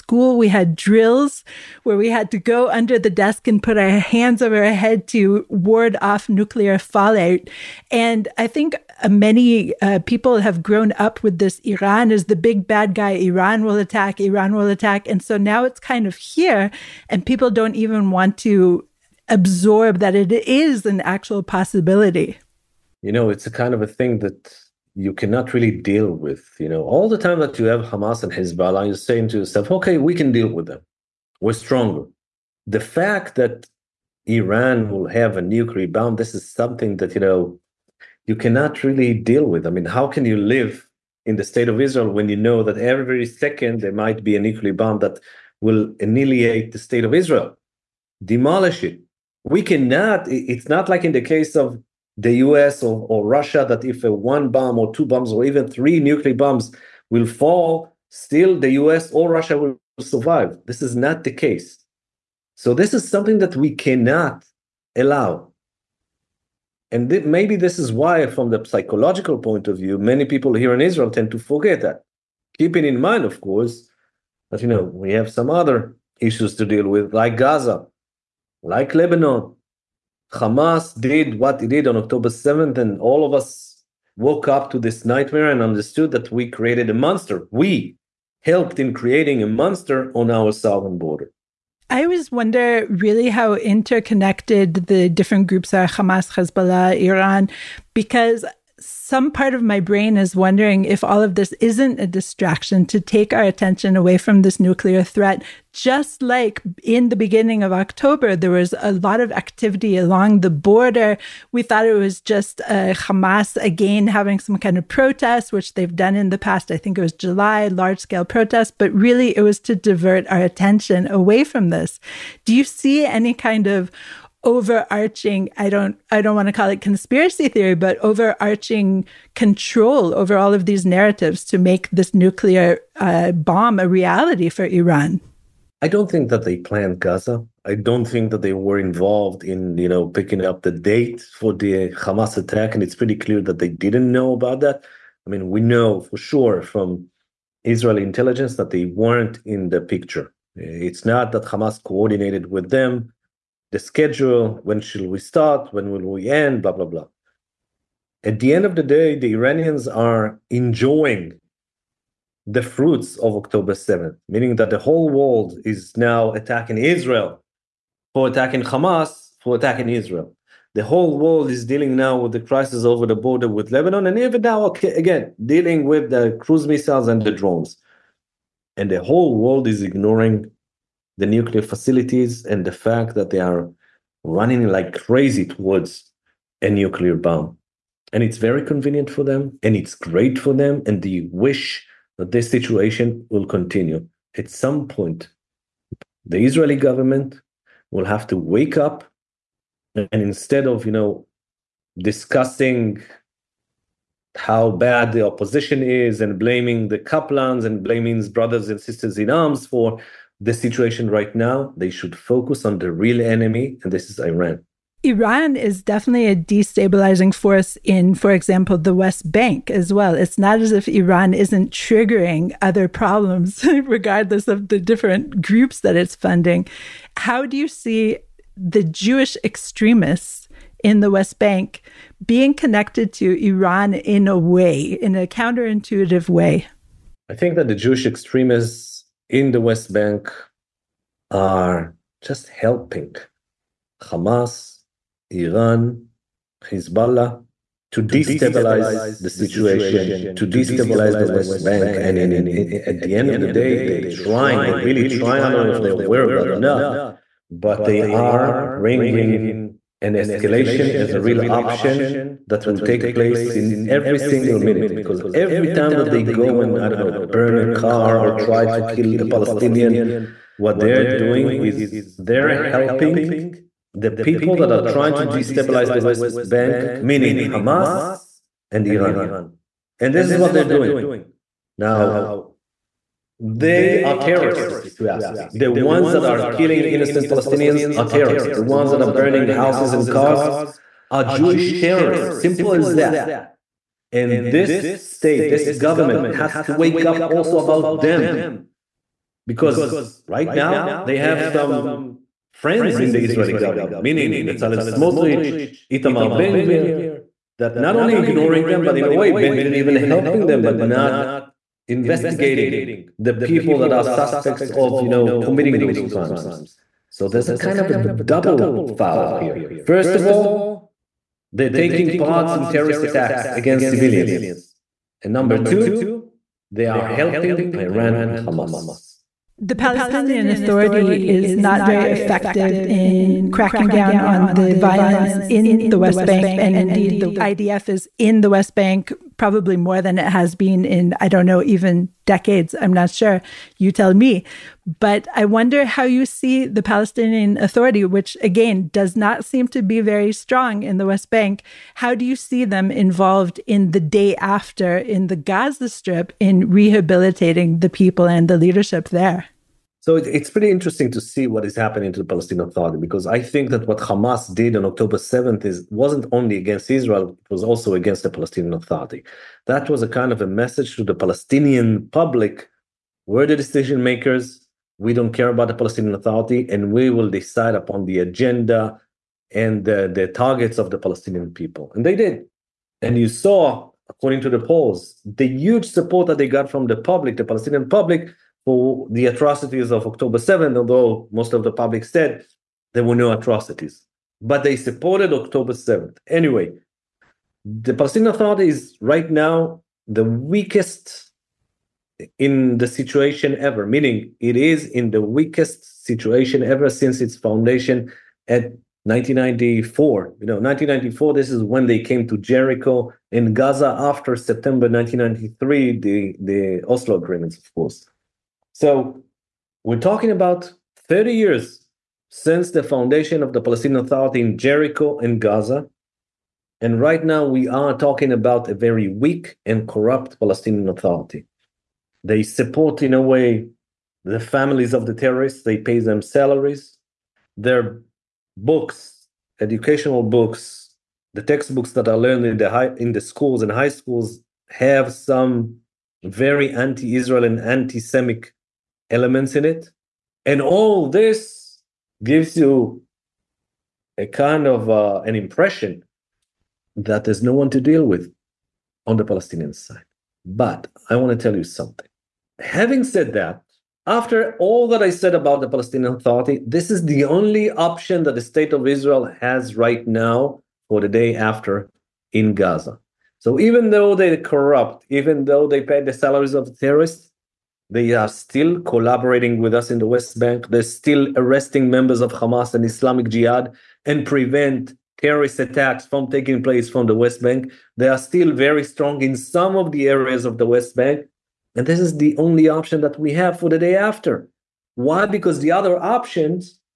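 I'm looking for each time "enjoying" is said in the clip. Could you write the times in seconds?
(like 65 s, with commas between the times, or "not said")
160 s.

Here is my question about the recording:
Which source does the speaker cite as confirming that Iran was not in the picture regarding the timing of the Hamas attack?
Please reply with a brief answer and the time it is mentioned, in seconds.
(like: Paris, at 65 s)
Israeli intelligence, at 147 s.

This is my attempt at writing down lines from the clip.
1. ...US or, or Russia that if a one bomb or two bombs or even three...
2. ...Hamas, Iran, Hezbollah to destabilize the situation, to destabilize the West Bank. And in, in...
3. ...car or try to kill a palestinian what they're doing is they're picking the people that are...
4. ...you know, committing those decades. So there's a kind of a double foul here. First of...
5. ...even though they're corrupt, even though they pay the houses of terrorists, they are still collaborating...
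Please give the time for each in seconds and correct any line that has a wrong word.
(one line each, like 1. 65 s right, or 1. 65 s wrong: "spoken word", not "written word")
1. 52 s right
2. 244 s right
3. 267 s wrong: "helping", not "picking"
4. 315 s wrong: "crimes", not "decades"
5. 473 s wrong: "salaries", not "houses".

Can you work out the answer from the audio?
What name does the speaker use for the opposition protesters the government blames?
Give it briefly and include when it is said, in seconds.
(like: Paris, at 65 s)
the Kaplans, at 206 s.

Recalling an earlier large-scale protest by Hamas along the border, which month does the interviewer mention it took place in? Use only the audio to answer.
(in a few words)
July.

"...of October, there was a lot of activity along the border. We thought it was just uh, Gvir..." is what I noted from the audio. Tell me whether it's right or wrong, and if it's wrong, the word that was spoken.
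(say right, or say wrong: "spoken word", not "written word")
wrong: "Hamas", not "Gvir".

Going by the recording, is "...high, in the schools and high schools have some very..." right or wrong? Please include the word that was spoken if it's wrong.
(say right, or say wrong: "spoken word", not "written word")
right.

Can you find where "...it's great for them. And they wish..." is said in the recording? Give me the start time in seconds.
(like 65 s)
189 s.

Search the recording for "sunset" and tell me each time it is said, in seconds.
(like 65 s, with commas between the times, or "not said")
not said.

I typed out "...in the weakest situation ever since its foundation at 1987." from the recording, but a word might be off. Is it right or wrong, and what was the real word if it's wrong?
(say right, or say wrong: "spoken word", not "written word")
wrong: "1994", not "1987".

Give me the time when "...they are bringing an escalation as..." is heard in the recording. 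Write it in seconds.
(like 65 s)
257 s.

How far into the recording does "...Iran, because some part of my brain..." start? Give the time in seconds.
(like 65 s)
96 s.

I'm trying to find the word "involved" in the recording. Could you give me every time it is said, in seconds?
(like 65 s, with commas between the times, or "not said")
138 s, 352 s.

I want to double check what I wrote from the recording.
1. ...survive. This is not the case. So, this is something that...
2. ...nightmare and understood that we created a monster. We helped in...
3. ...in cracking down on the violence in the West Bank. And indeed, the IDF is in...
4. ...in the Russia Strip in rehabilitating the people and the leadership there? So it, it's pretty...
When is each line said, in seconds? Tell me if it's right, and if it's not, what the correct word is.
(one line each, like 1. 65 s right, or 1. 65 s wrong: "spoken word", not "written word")
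1. 59 s right
2. 85 s right
3. 332 s right
4. 354 s wrong: "Gaza", not "Russia".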